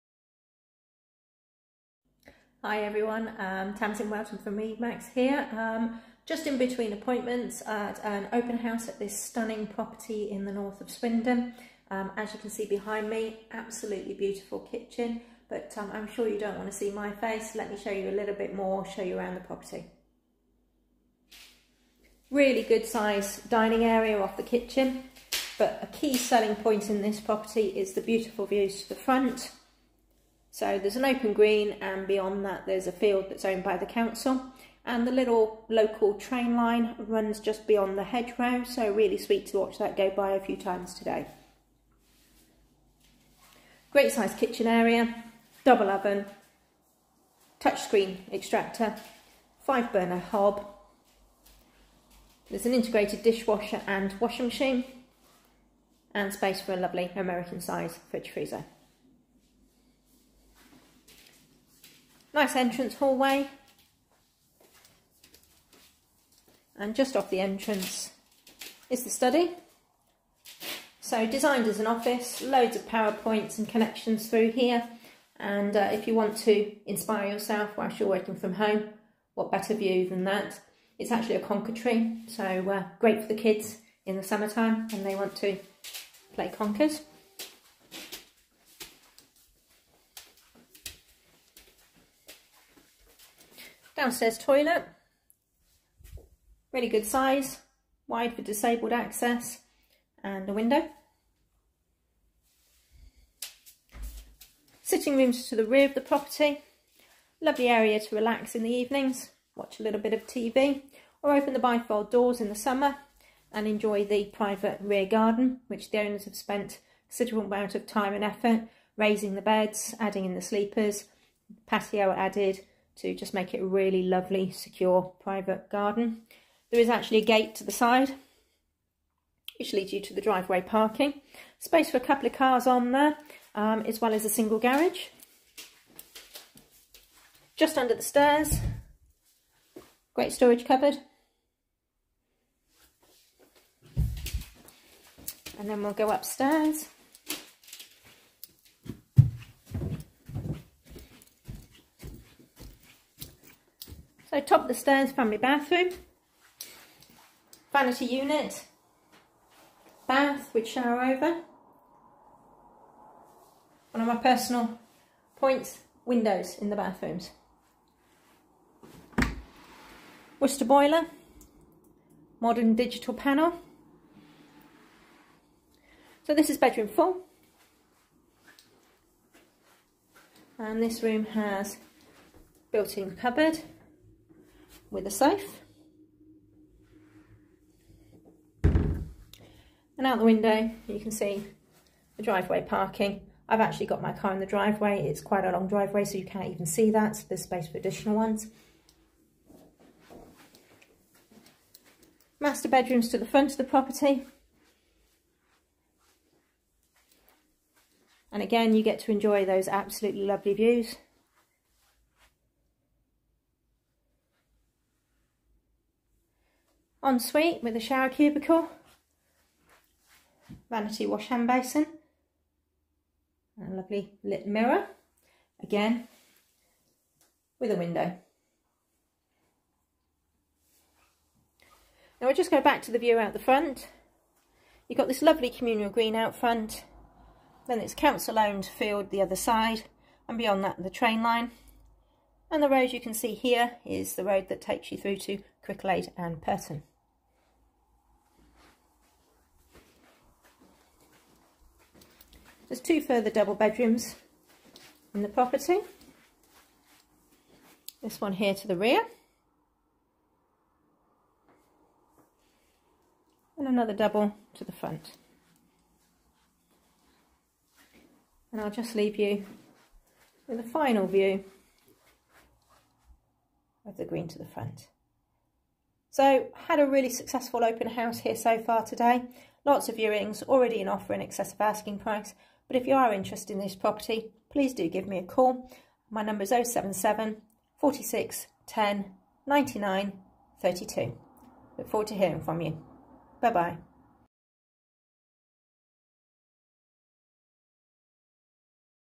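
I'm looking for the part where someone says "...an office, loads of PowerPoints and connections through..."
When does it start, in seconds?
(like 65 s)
71 s.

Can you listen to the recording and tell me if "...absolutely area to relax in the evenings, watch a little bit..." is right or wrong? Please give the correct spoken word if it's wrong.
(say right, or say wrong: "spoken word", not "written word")
wrong: "lovely", not "absolutely".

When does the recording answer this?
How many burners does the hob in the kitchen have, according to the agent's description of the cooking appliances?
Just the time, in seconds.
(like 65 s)
49 s.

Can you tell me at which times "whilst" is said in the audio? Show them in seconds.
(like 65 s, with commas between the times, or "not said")
77 s.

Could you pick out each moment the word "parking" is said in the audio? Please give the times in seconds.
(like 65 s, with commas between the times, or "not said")
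130 s, 192 s.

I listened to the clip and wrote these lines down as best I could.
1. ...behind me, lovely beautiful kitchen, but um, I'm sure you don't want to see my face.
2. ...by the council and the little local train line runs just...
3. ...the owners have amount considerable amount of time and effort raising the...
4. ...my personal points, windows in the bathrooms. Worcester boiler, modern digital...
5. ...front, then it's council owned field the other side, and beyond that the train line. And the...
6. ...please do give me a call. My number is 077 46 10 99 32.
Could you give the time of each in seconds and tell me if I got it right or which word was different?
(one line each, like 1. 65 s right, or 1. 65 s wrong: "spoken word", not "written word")
1. 12 s wrong: "absolutely", not "lovely"
2. 33 s right
3. 115 s wrong: "spent", not "amount"
4. 164 s right
5. 236 s right
6. 284 s right.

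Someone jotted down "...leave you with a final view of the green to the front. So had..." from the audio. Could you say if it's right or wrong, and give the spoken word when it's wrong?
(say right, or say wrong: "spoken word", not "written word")
right.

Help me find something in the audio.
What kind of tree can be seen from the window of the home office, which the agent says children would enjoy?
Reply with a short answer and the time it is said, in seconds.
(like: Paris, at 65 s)
Conker tree, at 81 s.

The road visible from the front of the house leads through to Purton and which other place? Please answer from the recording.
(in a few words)
Cricklade.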